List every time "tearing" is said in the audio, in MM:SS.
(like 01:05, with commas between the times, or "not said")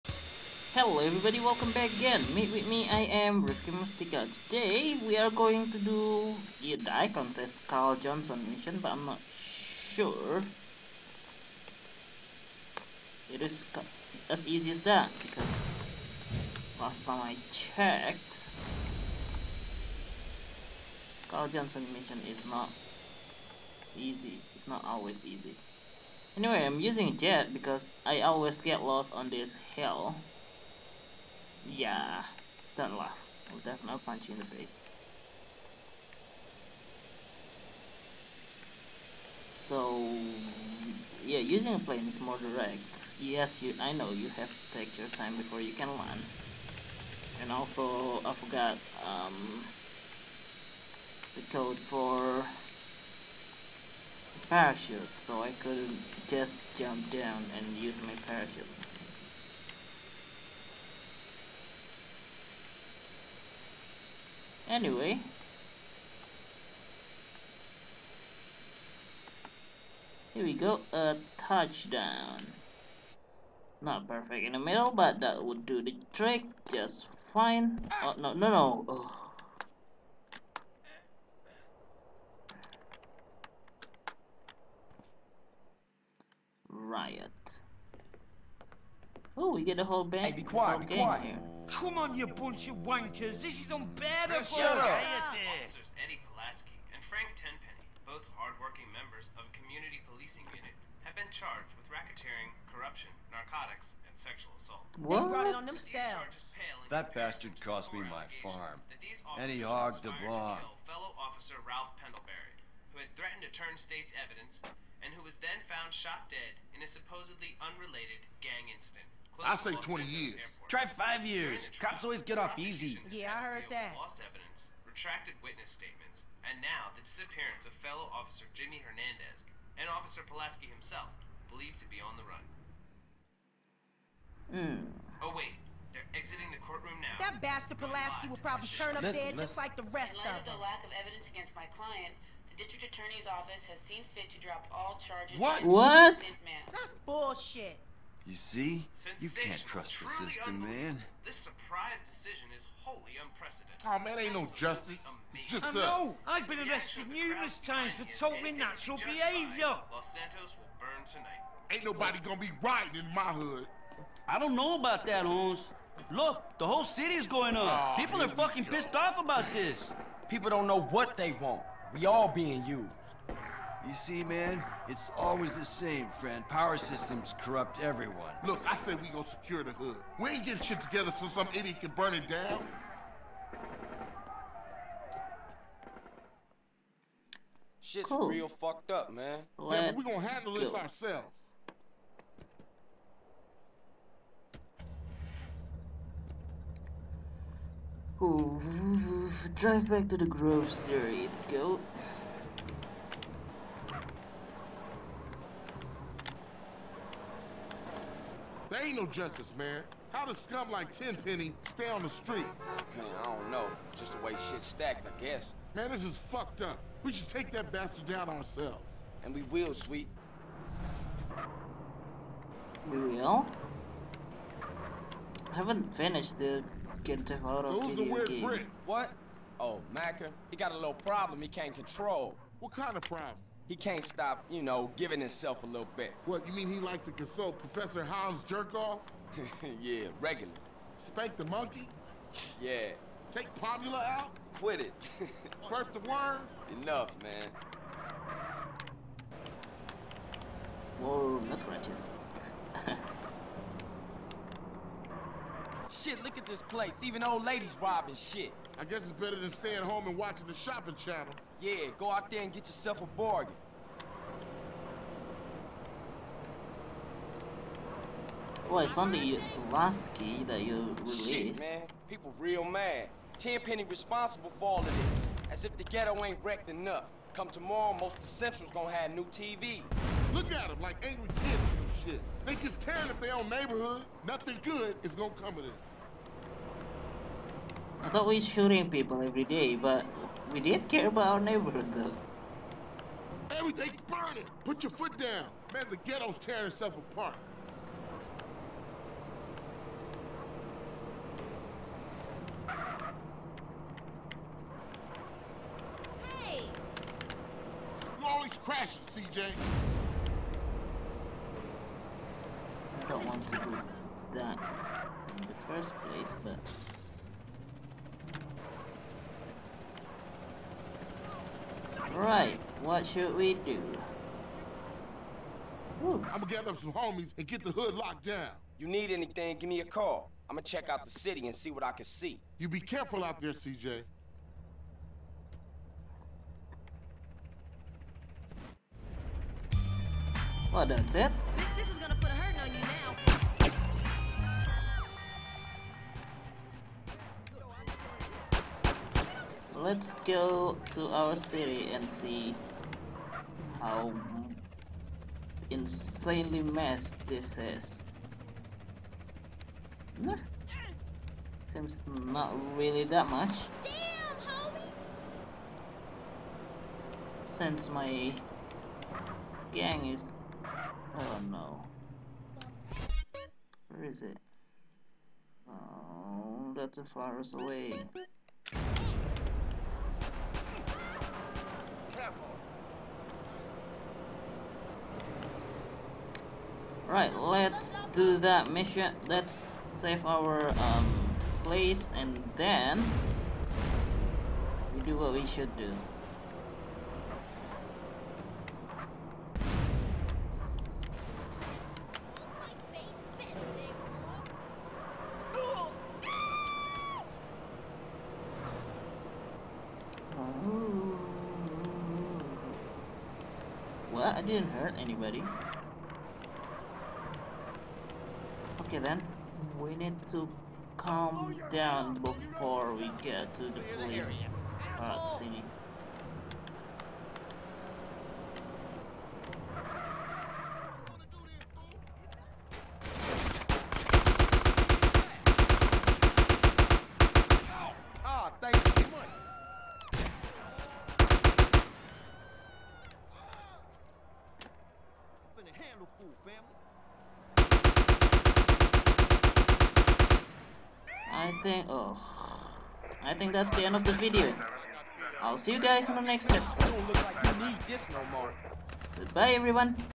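04:42, 04:56.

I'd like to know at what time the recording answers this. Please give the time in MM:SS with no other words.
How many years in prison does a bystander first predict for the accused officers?
01:59.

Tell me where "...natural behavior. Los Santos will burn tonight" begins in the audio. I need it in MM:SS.
02:38.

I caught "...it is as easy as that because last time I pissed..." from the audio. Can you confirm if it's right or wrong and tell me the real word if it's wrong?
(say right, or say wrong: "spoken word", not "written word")
wrong: "checked", not "pissed".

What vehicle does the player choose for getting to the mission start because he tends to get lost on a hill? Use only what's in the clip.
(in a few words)
Jet.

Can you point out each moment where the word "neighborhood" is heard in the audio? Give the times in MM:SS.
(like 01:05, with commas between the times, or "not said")
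04:43, 04:51.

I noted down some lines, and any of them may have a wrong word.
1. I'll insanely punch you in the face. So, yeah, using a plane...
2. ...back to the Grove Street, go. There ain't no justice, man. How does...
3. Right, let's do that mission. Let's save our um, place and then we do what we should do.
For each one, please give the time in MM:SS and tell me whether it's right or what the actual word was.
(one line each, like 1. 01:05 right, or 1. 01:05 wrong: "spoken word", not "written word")
1. 00:33 wrong: "definitely", not "insanely"
2. 03:19 right
3. 06:27 right.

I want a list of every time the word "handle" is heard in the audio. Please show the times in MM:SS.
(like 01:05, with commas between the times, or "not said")
03:10, 07:25.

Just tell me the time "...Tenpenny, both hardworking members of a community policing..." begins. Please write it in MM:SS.
01:37.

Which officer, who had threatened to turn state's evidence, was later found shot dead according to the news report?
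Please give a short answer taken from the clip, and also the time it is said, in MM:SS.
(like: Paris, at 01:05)
Ralph Pendlebury, at 01:51.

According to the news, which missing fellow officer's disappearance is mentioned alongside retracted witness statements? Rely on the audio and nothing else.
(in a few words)
Jimmy Hernandez.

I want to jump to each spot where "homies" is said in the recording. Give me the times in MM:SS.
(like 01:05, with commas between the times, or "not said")
05:26.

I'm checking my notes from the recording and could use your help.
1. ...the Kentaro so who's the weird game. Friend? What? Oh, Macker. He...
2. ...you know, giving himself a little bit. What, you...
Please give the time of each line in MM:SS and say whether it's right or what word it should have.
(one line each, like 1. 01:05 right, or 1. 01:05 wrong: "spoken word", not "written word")
1. 03:46 right
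2. 03:54 right.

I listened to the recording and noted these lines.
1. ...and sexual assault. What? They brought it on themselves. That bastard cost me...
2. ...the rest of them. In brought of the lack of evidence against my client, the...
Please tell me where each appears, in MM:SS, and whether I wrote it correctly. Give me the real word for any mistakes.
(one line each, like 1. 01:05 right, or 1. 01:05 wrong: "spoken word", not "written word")
1. 01:44 right
2. 02:19 wrong: "light", not "brought".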